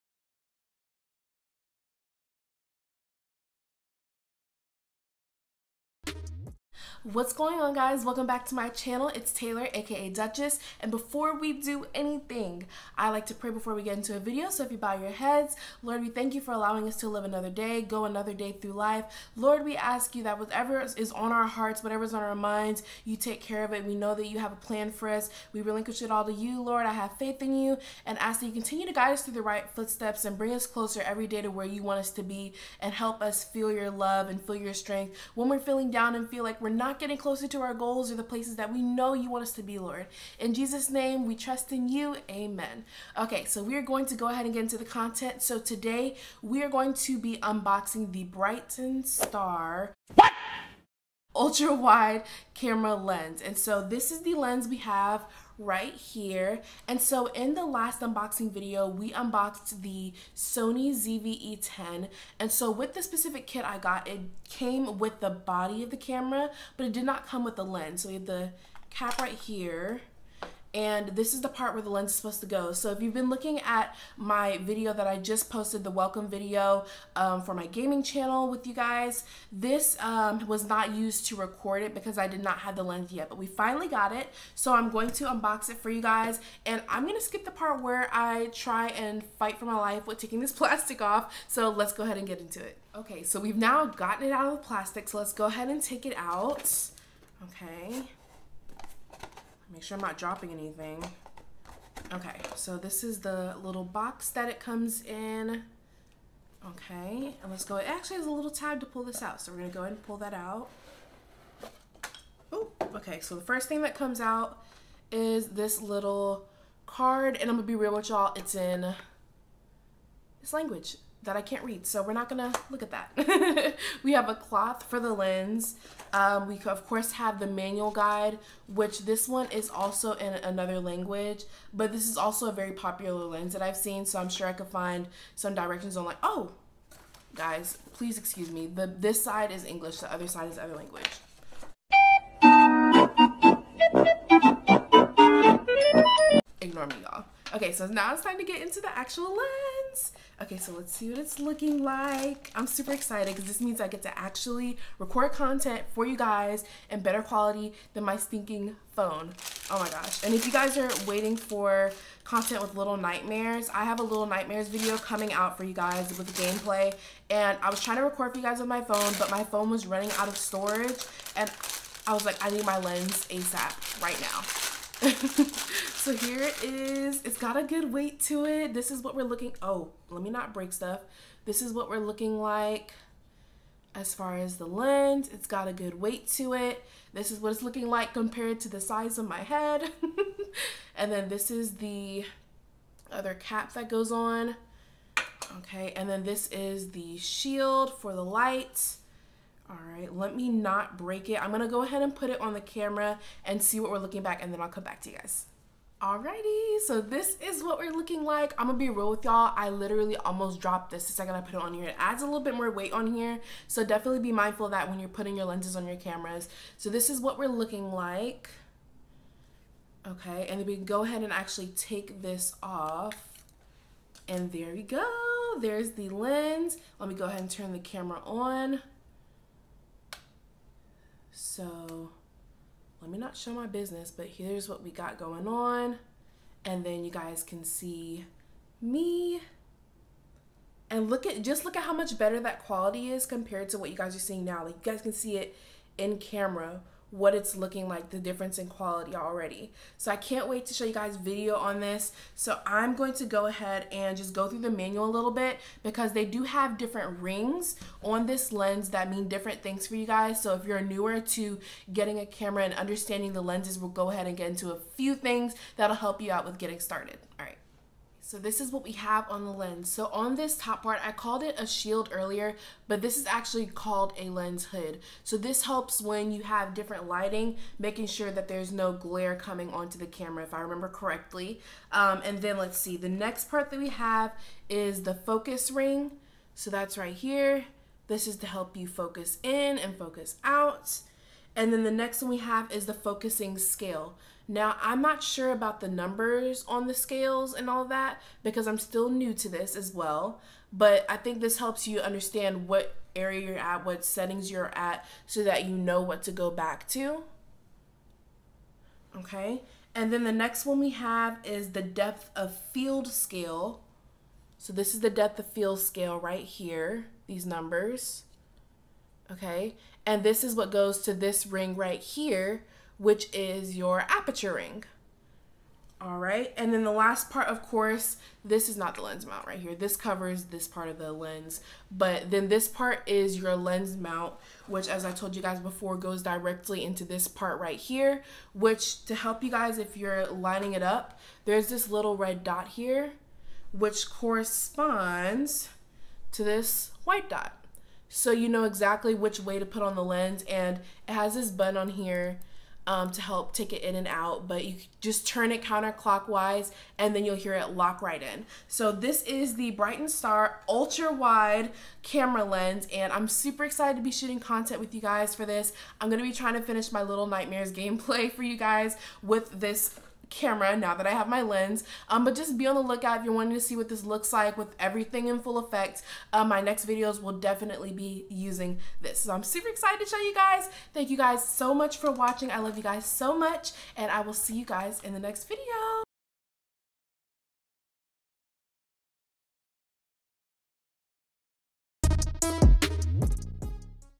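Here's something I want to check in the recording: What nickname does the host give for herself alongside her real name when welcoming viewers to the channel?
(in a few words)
Duchess.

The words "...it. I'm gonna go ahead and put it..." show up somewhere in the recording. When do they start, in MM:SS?
03:21.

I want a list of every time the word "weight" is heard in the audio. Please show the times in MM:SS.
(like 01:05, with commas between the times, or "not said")
02:57, 03:05, 03:32.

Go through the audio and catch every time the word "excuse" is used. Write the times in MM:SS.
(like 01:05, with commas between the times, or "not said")
02:18.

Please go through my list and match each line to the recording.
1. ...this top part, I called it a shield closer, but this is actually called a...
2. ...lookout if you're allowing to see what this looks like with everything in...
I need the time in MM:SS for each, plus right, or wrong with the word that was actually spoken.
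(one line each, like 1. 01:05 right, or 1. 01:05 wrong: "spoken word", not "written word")
1. 04:30 wrong: "earlier", not "closer"
2. 06:12 wrong: "wanting", not "allowing".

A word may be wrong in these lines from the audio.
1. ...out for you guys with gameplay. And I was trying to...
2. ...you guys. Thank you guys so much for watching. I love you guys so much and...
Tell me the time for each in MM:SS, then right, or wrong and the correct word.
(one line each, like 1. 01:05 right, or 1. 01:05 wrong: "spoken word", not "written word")
1. 02:45 right
2. 06:20 right.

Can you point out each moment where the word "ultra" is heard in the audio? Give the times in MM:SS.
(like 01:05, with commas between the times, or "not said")
00:51, 06:00.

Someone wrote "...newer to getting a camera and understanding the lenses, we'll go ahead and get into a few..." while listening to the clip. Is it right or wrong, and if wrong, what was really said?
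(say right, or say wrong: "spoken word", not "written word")
right.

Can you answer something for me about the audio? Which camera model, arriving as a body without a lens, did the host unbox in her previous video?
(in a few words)
Sony ZV-E10.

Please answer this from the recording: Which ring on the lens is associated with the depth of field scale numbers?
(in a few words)
Aperture ring.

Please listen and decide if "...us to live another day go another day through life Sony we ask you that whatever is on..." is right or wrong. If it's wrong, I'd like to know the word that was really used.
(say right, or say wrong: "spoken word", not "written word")
wrong: "Lord", not "Sony".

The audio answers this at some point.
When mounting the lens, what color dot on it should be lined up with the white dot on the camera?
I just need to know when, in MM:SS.
05:42.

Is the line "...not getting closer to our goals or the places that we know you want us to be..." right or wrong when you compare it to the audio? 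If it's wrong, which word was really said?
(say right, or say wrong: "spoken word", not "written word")
right.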